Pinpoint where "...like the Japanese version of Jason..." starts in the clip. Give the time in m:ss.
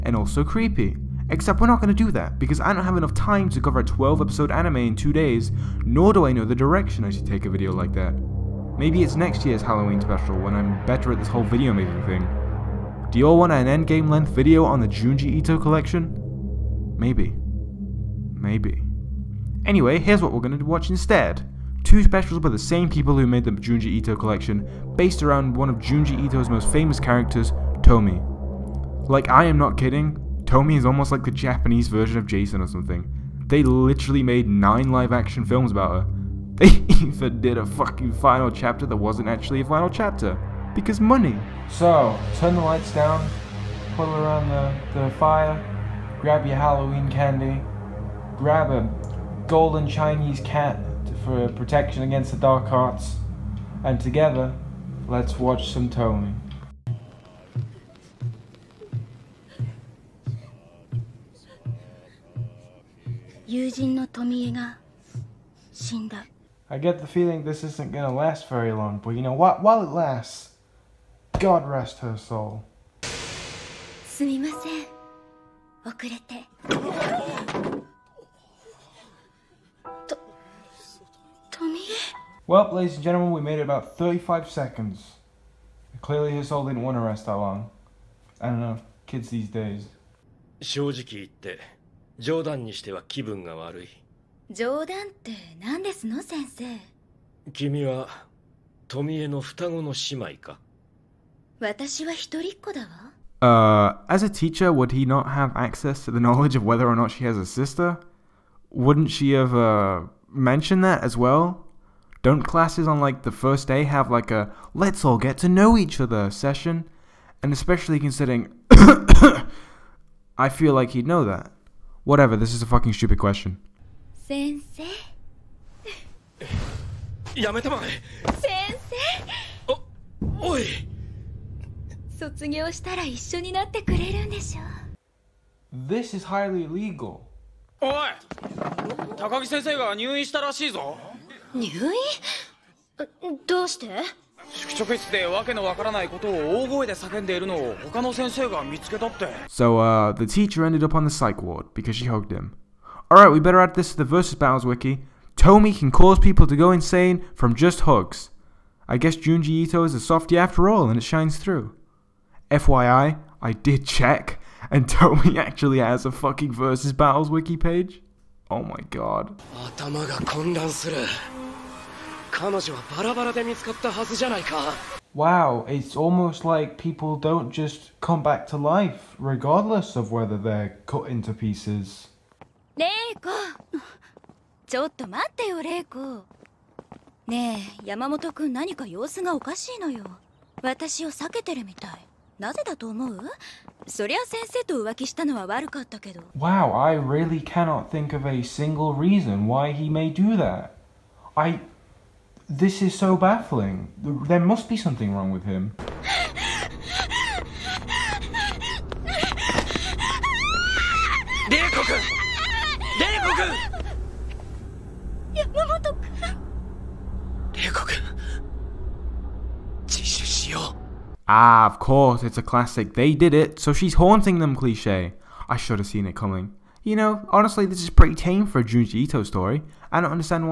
0:31.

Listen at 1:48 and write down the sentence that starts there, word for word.
Wouldn't she have uh, mentioned that as well?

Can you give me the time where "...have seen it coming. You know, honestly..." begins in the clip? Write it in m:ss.
3:45.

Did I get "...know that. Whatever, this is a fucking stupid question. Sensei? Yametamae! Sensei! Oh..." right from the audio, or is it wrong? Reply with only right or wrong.
right.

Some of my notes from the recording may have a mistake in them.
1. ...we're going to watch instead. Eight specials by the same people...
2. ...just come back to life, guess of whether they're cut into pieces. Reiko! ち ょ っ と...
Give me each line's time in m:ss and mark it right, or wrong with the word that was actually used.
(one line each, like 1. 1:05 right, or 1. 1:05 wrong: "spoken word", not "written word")
1. 0:20 wrong: "Two", not "Eight"
2. 2:57 wrong: "regardless", not "guess".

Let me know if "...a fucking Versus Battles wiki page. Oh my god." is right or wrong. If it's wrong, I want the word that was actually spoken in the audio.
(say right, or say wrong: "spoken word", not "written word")
right.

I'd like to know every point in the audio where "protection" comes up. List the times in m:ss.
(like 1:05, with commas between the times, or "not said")
0:51.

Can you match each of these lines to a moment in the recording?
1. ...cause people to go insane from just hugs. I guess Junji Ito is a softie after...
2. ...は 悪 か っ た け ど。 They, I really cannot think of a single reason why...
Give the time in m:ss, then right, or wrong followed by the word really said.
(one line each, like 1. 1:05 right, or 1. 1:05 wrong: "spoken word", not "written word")
1. 2:35 right
2. 3:15 wrong: "Wow", not "They".